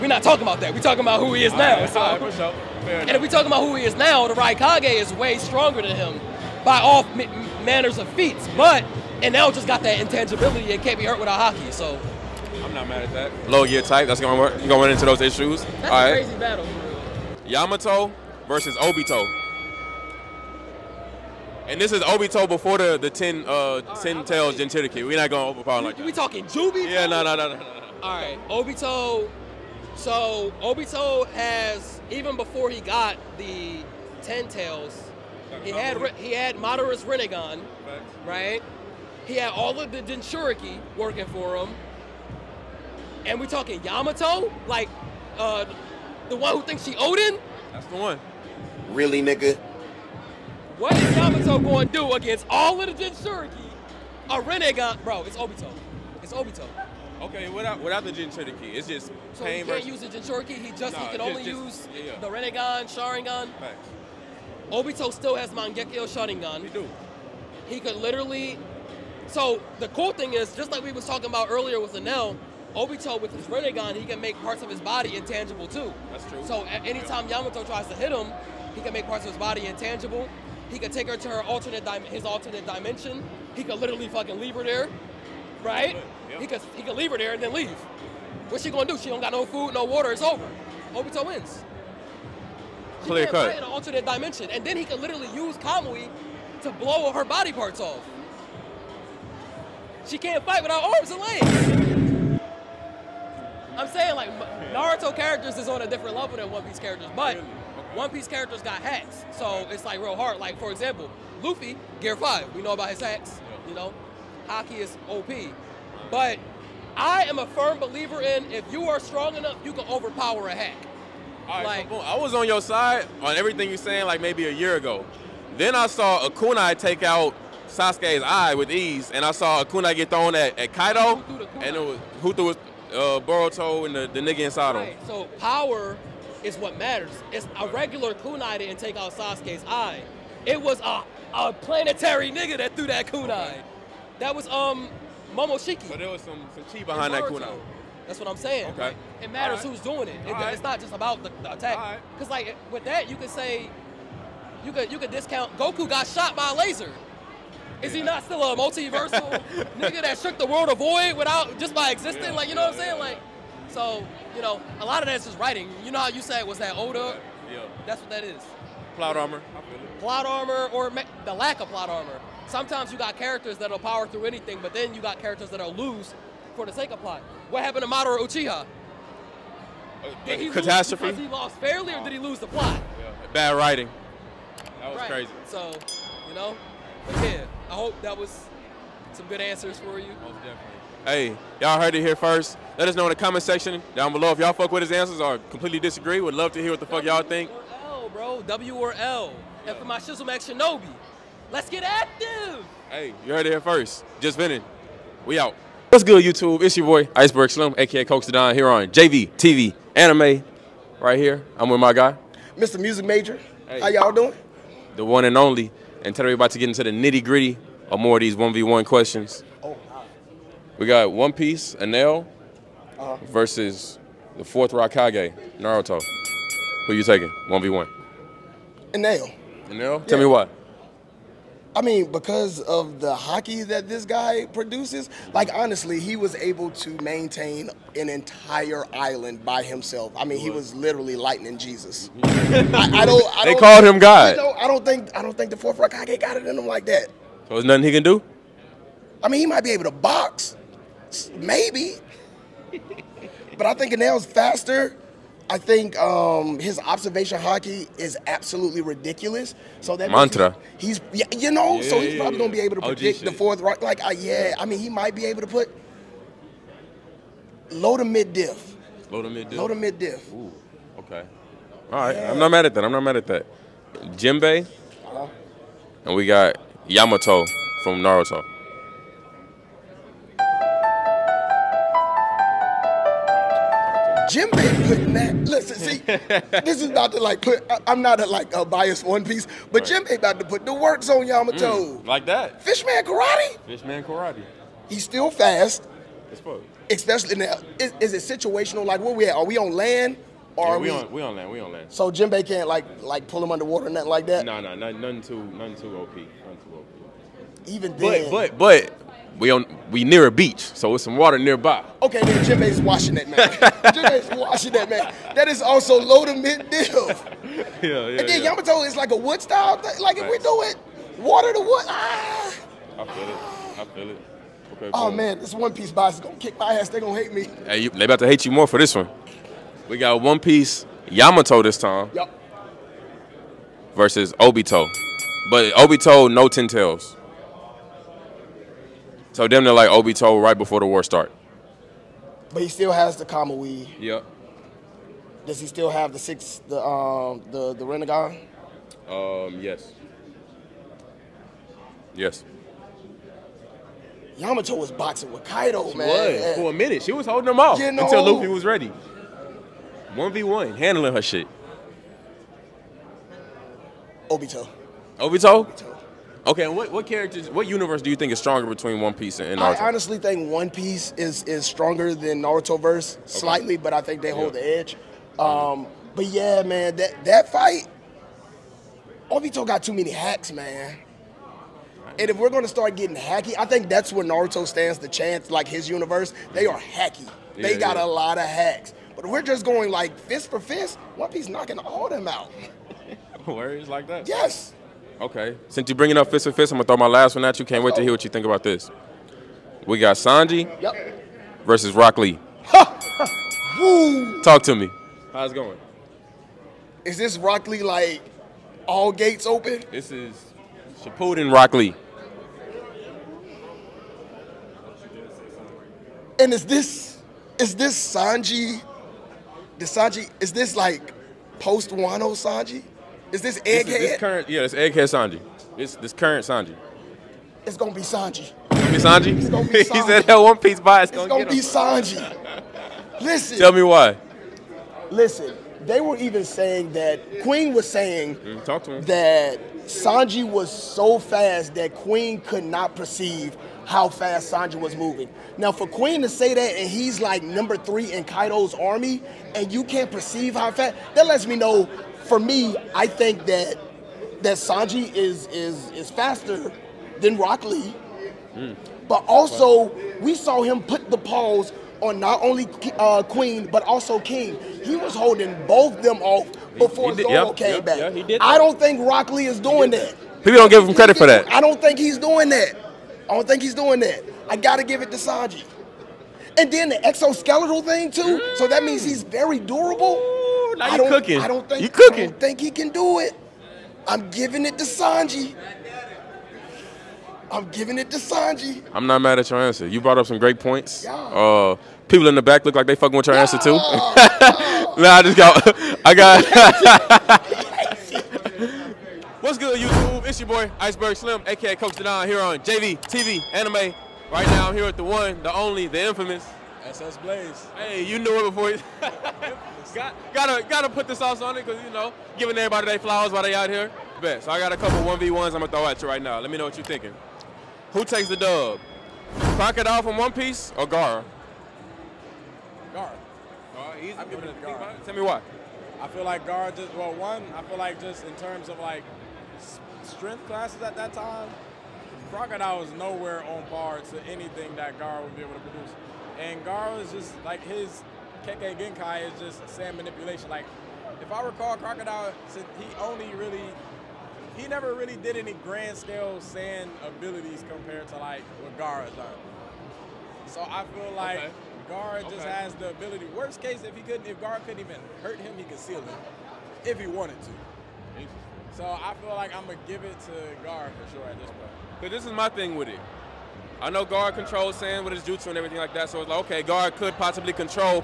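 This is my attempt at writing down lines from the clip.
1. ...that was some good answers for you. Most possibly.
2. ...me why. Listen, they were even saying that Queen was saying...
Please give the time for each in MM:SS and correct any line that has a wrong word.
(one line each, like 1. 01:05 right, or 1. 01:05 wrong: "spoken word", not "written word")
1. 03:08 wrong: "definitely", not "possibly"
2. 07:13 right.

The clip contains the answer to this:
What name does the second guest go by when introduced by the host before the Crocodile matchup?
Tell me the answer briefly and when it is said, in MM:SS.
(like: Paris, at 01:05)
SS Blaze, at 08:26.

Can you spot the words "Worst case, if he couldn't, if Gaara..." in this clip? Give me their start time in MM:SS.
09:13.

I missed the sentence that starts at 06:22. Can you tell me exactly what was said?
And if we're gonna start getting hacky, I think that's where Naruto stands the chance.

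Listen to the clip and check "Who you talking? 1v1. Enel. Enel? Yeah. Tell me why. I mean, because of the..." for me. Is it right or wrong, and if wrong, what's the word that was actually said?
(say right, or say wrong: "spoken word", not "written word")
wrong: "taking", not "talking".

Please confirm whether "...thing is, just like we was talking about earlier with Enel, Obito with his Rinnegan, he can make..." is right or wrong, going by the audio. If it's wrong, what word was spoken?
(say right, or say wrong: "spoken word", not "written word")
right.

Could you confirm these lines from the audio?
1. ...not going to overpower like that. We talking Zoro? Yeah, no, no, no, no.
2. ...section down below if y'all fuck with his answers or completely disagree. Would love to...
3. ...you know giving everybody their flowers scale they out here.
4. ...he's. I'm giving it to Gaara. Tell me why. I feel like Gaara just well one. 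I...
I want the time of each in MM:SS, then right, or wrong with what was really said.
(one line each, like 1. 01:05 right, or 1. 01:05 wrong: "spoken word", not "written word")
1. 00:25 wrong: "Juby", not "Zoro"
2. 03:13 right
3. 08:31 wrong: "while", not "scale"
4. 08:43 right.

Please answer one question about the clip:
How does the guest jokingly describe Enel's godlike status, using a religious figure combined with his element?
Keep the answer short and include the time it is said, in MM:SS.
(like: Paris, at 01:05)
lightning Jesus, at 04:01.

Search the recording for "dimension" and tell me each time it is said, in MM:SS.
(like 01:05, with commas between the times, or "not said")
01:22, 01:34.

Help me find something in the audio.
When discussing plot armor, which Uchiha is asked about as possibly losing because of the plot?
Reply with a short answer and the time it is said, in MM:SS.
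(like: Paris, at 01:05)
Madara Uchiha, at 02:57.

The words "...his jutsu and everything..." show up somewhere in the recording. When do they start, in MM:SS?
09:25.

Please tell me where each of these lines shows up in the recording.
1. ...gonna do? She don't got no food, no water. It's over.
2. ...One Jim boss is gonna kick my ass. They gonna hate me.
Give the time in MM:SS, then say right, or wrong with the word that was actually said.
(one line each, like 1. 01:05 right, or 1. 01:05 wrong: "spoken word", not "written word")
1. 01:28 right
2. 05:25 wrong: "Piece", not "Jim".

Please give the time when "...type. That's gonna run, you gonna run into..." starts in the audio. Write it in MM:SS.
00:13.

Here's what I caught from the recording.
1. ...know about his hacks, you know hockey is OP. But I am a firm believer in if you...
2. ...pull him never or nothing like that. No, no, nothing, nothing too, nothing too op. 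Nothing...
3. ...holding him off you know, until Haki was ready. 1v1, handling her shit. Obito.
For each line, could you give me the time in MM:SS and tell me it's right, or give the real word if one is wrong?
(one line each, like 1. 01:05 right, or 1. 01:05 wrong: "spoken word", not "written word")
1. 01:52 right
2. 05:03 wrong: "underwater", not "never"
3. 05:57 wrong: "Luffy", not "Haki".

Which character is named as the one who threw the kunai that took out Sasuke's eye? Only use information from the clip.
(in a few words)
Momoshiki.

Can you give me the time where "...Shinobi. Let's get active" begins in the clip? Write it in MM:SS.
03:20.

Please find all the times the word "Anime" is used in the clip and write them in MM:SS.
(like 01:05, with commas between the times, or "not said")
03:29, 08:23.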